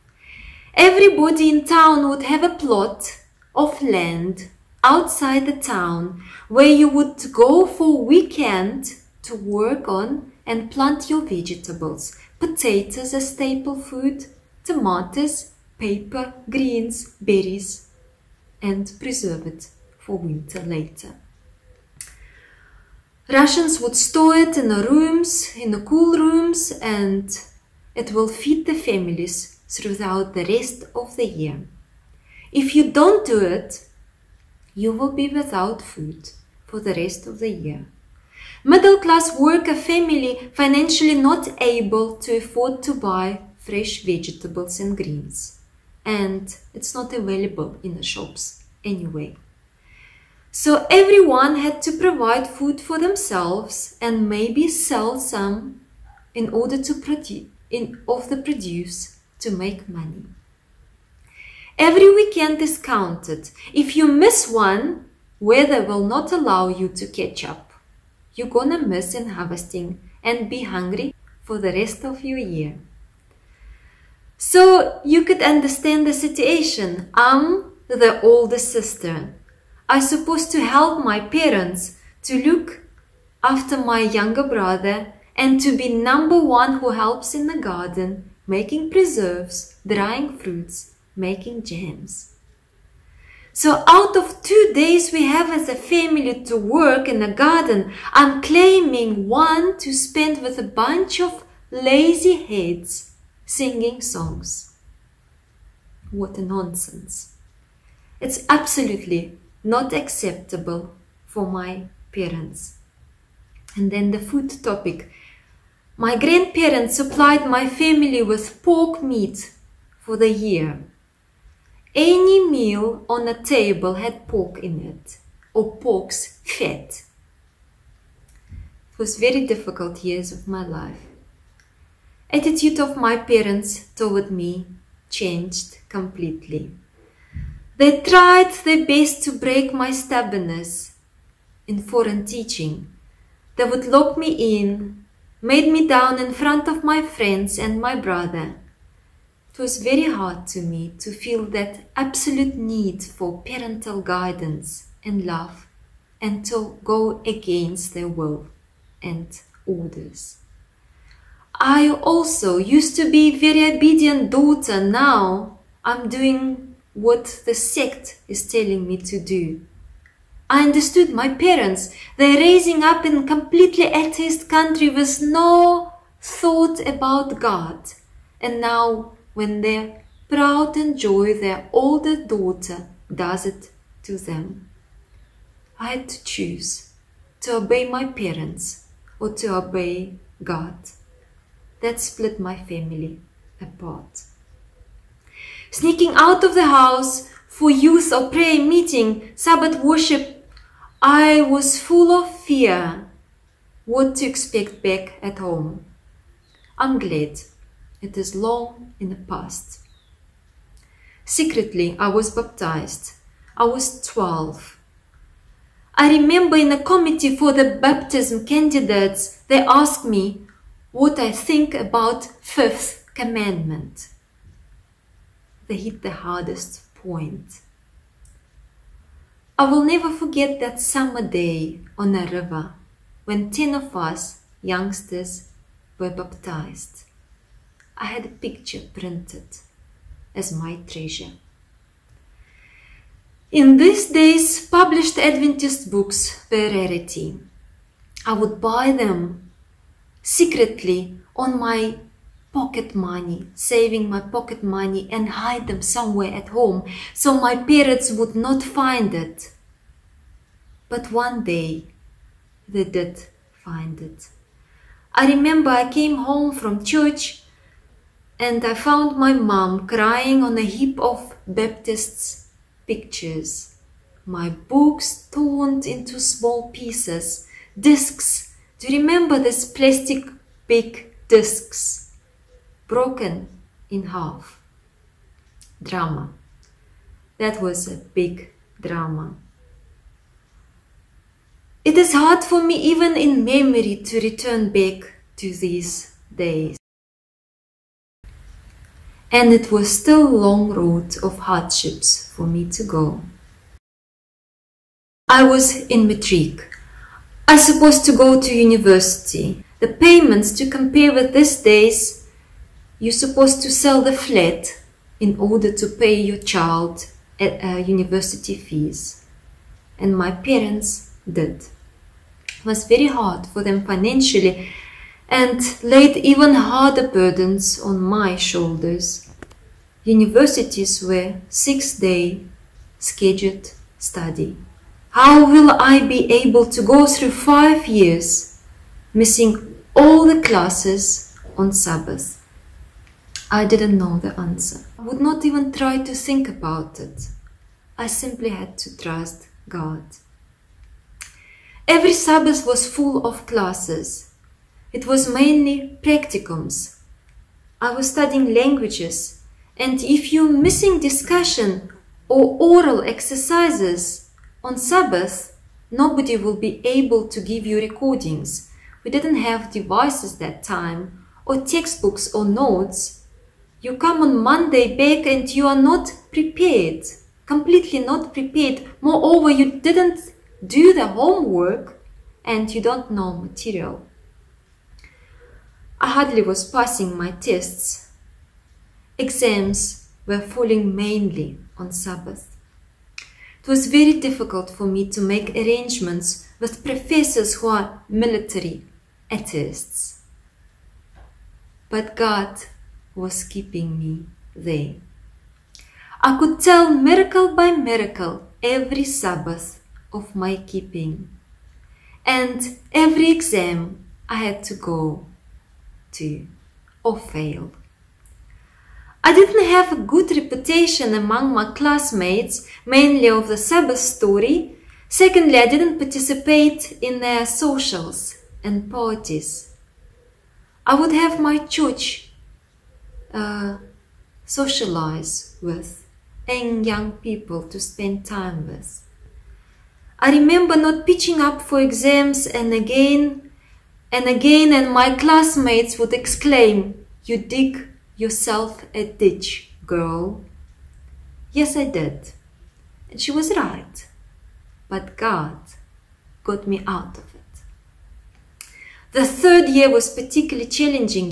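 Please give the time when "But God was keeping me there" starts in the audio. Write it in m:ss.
6:41.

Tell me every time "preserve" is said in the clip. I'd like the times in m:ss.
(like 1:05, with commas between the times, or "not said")
0:18, 1:28.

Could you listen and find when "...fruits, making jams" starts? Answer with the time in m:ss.
1:30.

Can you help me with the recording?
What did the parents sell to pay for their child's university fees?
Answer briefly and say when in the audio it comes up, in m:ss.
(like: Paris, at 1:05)
The flat, at 5:14.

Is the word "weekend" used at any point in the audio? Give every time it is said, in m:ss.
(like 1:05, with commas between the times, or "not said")
0:08, 1:02.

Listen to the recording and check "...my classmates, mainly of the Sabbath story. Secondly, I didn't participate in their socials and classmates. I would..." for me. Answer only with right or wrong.
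wrong.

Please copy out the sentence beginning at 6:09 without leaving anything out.
We didn't have devices that time, or textbooks or notes.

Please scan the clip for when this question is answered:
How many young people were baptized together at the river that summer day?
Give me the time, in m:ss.
3:53.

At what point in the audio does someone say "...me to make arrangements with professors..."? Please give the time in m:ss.
6:34.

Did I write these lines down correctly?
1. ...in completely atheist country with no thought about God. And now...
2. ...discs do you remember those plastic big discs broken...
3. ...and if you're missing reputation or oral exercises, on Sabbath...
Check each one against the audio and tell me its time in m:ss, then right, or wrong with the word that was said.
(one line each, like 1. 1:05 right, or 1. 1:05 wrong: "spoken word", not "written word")
1. 2:53 right
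2. 4:37 right
3. 5:59 wrong: "discussion", not "reputation".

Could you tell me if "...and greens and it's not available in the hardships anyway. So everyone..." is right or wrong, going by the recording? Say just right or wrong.
wrong.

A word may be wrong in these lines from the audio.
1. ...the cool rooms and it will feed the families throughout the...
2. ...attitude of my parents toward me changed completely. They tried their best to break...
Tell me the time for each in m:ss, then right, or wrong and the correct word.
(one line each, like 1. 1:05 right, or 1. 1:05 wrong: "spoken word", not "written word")
1. 0:25 right
2. 2:12 right.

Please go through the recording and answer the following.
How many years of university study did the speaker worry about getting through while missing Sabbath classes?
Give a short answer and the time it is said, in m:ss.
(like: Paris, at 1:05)
5, at 5:37.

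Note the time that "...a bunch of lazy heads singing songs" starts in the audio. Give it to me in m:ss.
1:40.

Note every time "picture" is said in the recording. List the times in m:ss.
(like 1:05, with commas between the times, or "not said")
3:58, 4:32.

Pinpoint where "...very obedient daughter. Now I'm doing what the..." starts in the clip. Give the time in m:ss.
2:43.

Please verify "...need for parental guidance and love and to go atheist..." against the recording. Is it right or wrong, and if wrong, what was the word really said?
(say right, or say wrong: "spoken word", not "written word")
wrong: "against", not "atheist".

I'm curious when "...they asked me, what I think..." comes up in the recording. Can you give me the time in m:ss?
3:39.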